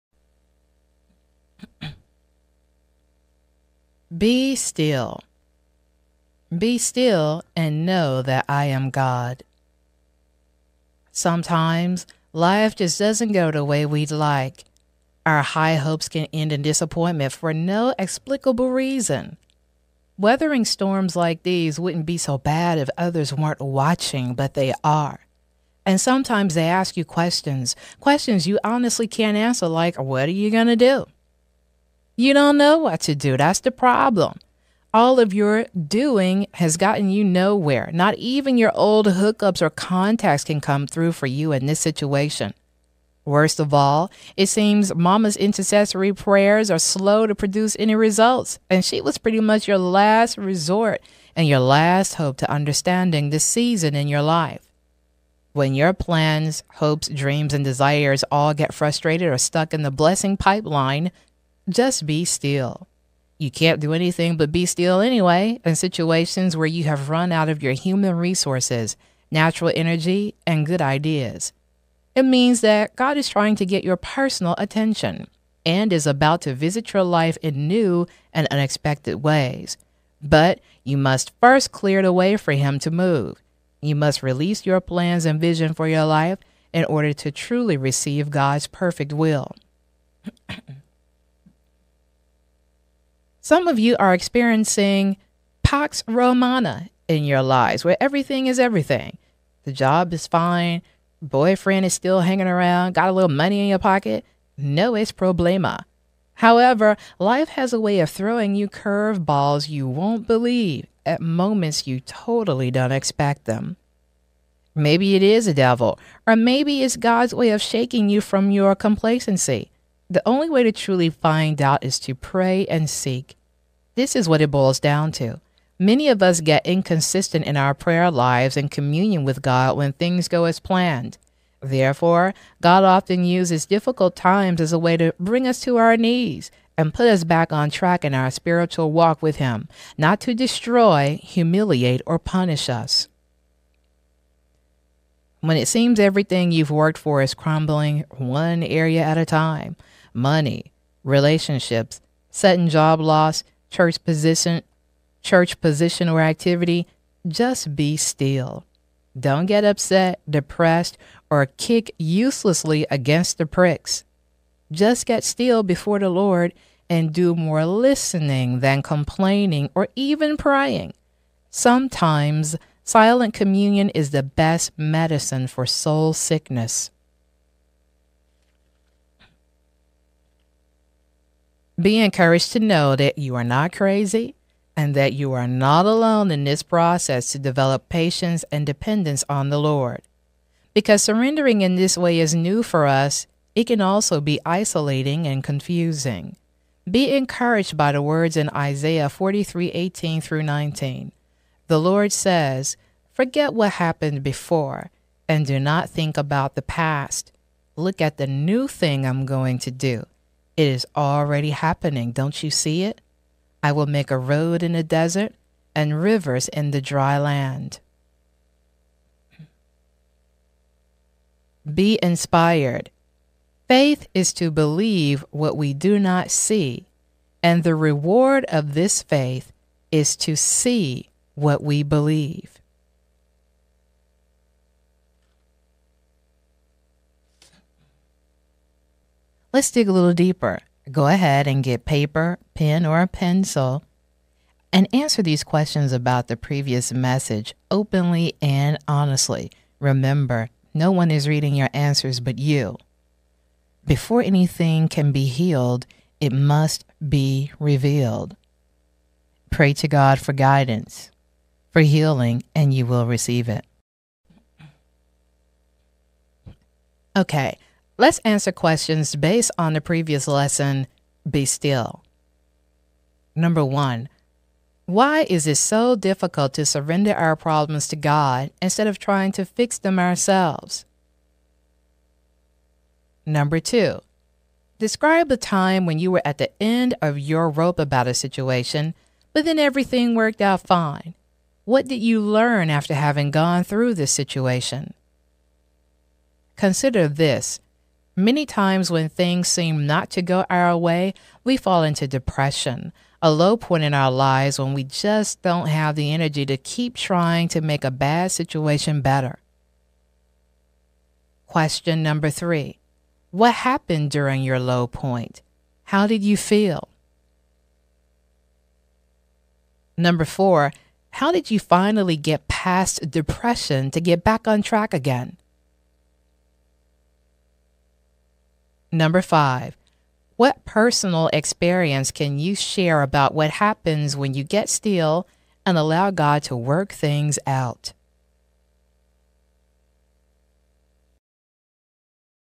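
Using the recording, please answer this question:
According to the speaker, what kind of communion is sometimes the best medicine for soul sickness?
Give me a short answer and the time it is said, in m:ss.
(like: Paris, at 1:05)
Silent communion, at 2:52.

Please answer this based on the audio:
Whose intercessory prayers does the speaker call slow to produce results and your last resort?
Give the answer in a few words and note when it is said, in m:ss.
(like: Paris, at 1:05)
Mama's, at 0:44.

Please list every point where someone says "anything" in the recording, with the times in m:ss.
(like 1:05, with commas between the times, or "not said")
1:03, 4:14.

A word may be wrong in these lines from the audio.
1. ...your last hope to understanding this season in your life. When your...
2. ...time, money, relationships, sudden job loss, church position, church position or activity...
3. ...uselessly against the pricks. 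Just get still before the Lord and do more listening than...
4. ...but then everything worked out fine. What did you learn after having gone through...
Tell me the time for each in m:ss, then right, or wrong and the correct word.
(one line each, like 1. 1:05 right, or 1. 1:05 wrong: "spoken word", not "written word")
1. 0:51 right
2. 2:29 right
3. 2:41 right
4. 4:49 right.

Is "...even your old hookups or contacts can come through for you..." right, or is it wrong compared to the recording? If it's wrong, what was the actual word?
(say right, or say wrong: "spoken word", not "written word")
right.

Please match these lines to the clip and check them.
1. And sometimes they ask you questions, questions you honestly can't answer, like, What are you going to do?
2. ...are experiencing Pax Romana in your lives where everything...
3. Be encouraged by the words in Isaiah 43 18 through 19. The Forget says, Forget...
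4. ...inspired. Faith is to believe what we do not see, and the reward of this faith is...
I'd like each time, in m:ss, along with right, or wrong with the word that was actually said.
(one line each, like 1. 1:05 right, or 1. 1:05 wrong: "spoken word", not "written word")
1. 0:25 right
2. 1:33 right
3. 3:16 wrong: "Lord", not "Forget"
4. 3:42 right.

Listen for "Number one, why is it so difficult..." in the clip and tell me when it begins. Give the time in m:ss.
4:33.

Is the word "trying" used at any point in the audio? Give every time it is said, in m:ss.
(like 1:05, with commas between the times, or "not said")
1:13, 4:38, 5:06.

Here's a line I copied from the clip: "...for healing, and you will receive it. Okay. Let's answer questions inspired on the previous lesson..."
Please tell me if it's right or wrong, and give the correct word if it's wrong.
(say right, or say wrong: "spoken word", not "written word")
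wrong: "based", not "inspired".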